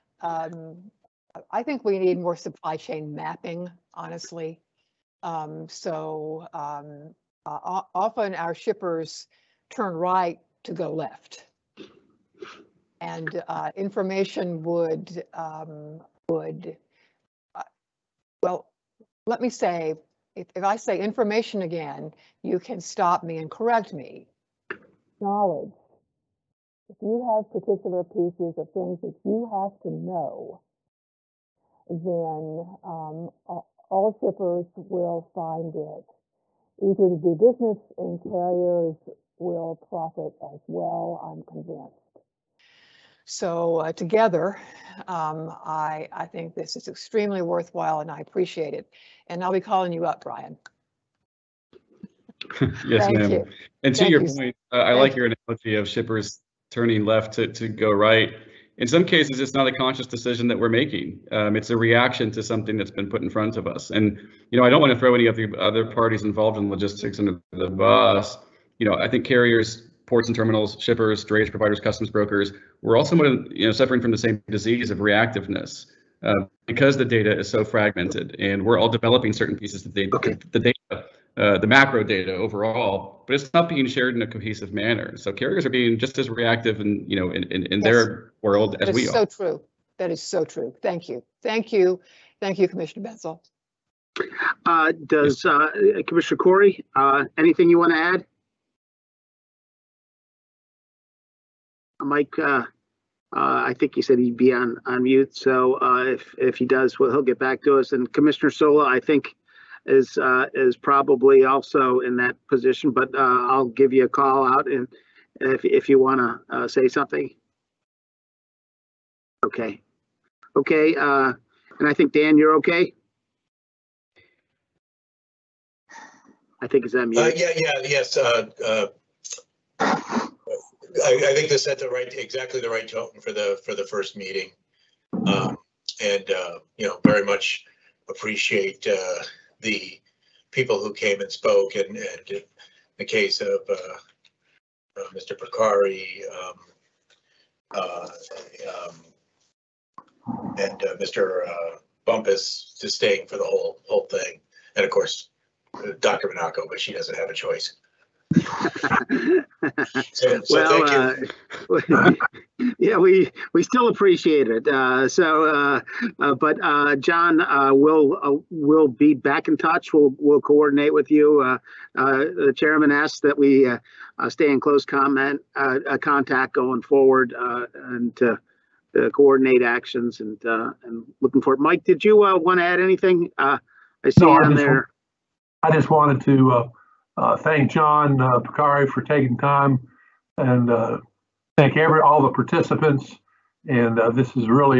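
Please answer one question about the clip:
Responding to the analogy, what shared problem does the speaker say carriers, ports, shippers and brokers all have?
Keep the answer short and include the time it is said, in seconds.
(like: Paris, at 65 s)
reactiveness, at 74 s.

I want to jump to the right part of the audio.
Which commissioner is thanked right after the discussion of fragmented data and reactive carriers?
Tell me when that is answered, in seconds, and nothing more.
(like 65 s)
92 s.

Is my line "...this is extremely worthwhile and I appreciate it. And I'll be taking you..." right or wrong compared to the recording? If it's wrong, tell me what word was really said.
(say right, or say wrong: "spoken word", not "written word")
wrong: "calling", not "taking".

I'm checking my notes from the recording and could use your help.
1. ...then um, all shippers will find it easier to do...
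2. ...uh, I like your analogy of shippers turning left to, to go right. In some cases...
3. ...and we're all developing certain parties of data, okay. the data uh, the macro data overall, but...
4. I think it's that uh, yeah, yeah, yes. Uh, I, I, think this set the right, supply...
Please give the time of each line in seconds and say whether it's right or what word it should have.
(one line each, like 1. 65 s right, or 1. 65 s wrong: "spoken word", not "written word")
1. 31 s right
2. 54 s right
3. 78 s wrong: "pieces", not "parties"
4. 126 s wrong: "exactly", not "supply".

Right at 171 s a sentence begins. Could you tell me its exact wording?
the chairman asked that we stay in close comment contact going forward and to, coordinate actions and and looking for it.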